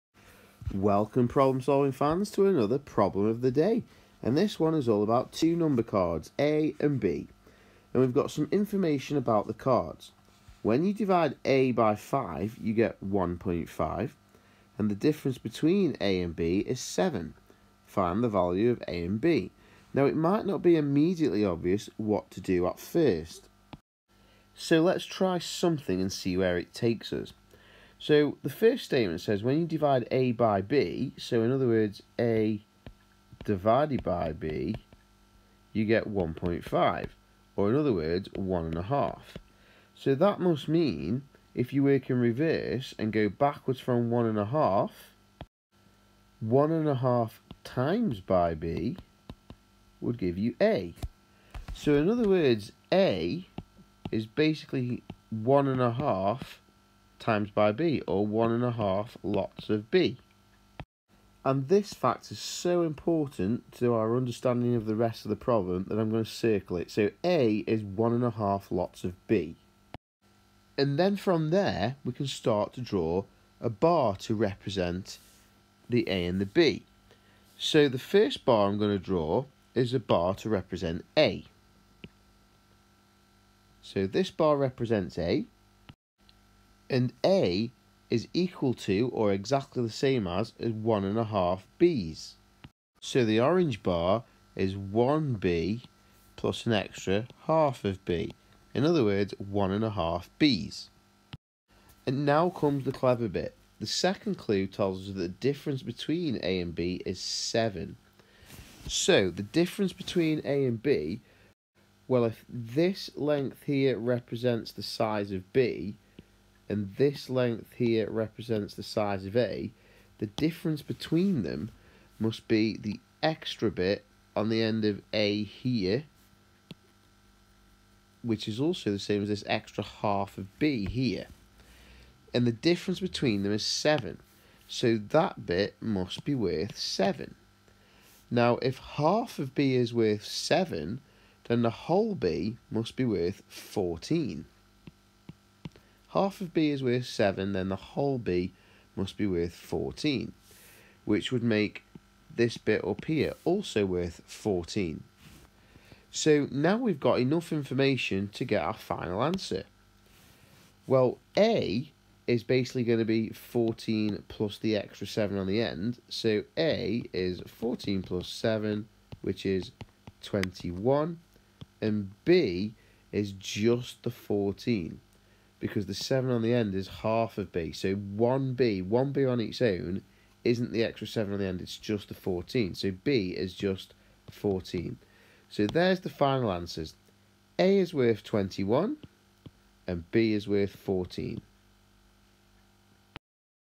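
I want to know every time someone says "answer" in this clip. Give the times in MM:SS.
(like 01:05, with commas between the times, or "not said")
02:39, 03:06.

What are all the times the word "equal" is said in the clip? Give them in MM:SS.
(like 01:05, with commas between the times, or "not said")
01:28.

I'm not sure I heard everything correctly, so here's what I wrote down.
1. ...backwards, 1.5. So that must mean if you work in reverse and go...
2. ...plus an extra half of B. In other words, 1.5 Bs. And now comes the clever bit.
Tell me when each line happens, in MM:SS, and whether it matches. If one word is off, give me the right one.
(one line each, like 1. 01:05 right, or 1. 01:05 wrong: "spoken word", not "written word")
1. 00:37 wrong: "words", not "backwards"
2. 01:36 right.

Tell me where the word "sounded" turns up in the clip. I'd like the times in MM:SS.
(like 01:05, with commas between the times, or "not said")
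not said.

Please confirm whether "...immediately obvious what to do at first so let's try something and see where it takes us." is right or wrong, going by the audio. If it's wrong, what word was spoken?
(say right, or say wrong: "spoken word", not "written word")
right.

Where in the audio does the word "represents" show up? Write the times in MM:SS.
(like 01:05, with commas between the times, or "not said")
01:14, 01:20, 01:24, 01:53, 01:58.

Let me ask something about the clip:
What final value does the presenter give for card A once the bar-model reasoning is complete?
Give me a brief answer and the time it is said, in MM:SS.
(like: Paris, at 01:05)
21, at 02:49.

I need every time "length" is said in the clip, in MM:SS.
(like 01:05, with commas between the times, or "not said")
01:53, 01:57.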